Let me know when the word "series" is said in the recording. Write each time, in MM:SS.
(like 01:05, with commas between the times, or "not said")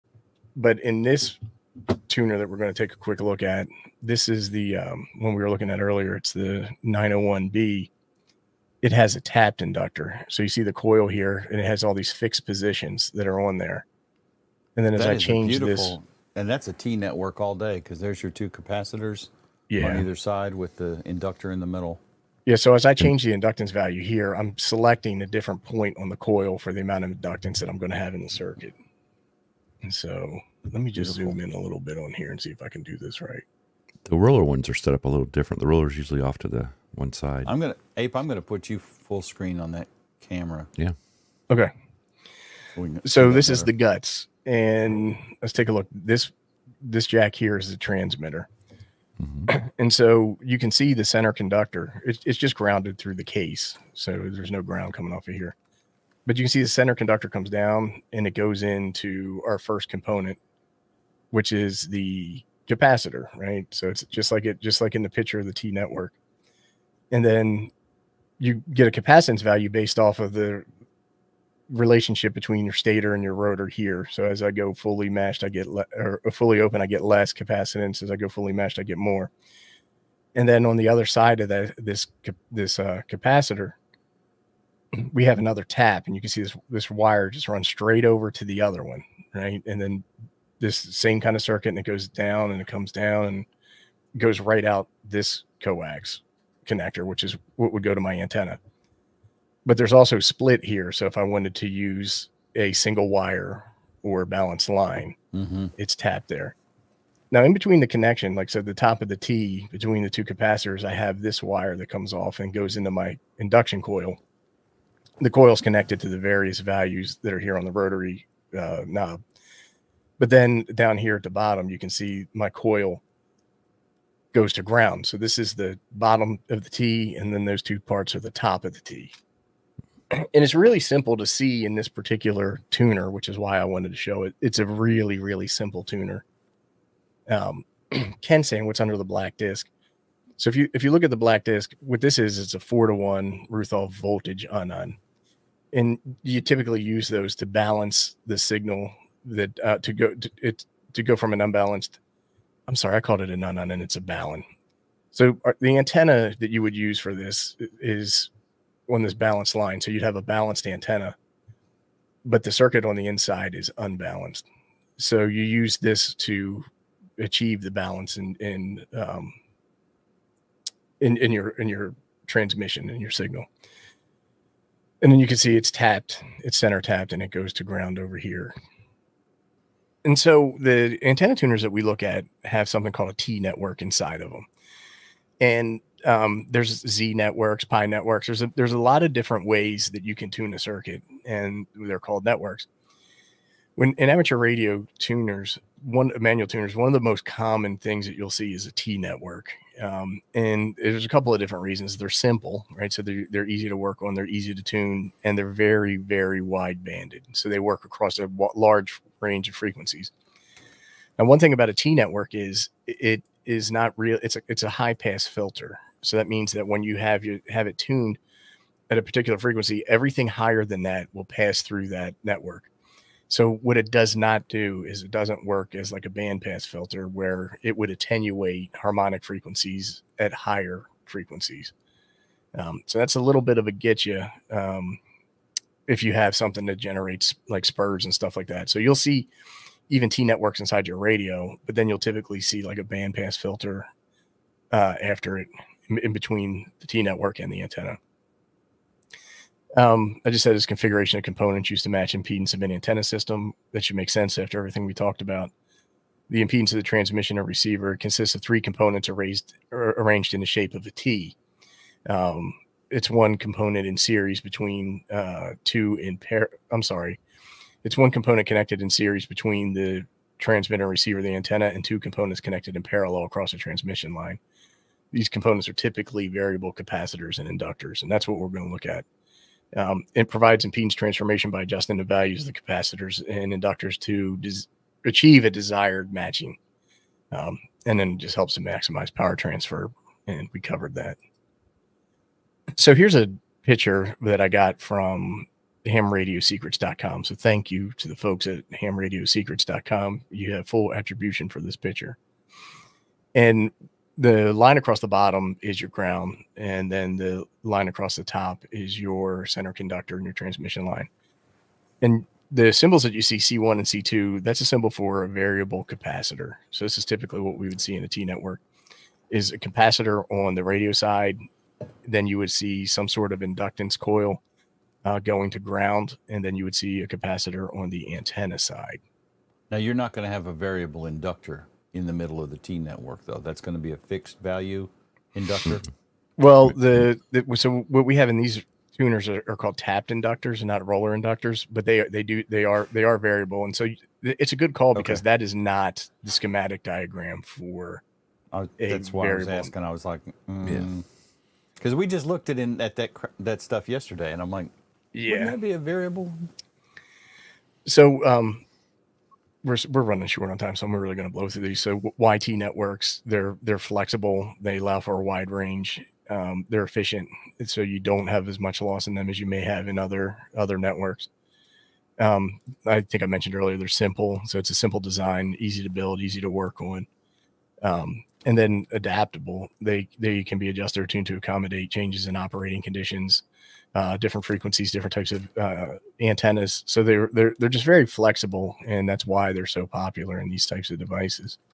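04:23, 04:28.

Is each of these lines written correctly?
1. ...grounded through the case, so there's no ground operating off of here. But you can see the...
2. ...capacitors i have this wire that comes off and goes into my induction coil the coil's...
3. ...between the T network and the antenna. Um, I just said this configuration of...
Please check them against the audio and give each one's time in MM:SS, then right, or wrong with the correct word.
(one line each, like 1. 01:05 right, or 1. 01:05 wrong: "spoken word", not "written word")
1. 00:52 wrong: "coming", not "operating"
2. 01:50 right
3. 04:06 right.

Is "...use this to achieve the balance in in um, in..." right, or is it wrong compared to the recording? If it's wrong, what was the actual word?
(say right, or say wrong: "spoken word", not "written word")
right.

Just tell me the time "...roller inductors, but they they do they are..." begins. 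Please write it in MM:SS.
05:40.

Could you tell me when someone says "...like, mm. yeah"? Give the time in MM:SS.
05:50.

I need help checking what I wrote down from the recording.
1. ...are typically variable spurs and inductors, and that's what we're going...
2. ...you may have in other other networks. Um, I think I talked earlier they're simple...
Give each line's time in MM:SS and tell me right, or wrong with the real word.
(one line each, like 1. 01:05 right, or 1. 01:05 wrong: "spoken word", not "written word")
1. 04:35 wrong: "capacitors", not "spurs"
2. 06:09 wrong: "mentioned", not "talked".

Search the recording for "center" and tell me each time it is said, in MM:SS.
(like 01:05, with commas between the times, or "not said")
00:51, 00:56, 02:56, 05:09.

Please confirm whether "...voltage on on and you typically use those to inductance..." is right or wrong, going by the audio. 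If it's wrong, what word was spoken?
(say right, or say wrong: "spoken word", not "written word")
wrong: "balance", not "inductance".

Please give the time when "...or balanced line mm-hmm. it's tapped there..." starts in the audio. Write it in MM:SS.
01:44.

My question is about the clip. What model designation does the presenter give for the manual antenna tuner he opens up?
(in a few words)
901B.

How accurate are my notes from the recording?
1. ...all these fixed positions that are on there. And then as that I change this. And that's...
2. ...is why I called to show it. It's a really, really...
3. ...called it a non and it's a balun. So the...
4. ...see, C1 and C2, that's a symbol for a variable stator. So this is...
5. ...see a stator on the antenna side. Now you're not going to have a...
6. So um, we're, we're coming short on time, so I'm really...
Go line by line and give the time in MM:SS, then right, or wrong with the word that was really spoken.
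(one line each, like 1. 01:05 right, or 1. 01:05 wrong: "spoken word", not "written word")
1. 00:11 right
2. 02:13 wrong: "wanted", not "called"
3. 02:32 right
4. 05:13 wrong: "capacitor", not "stator"
5. 05:26 wrong: "capacitor", not "stator"
6. 05:57 wrong: "running", not "coming".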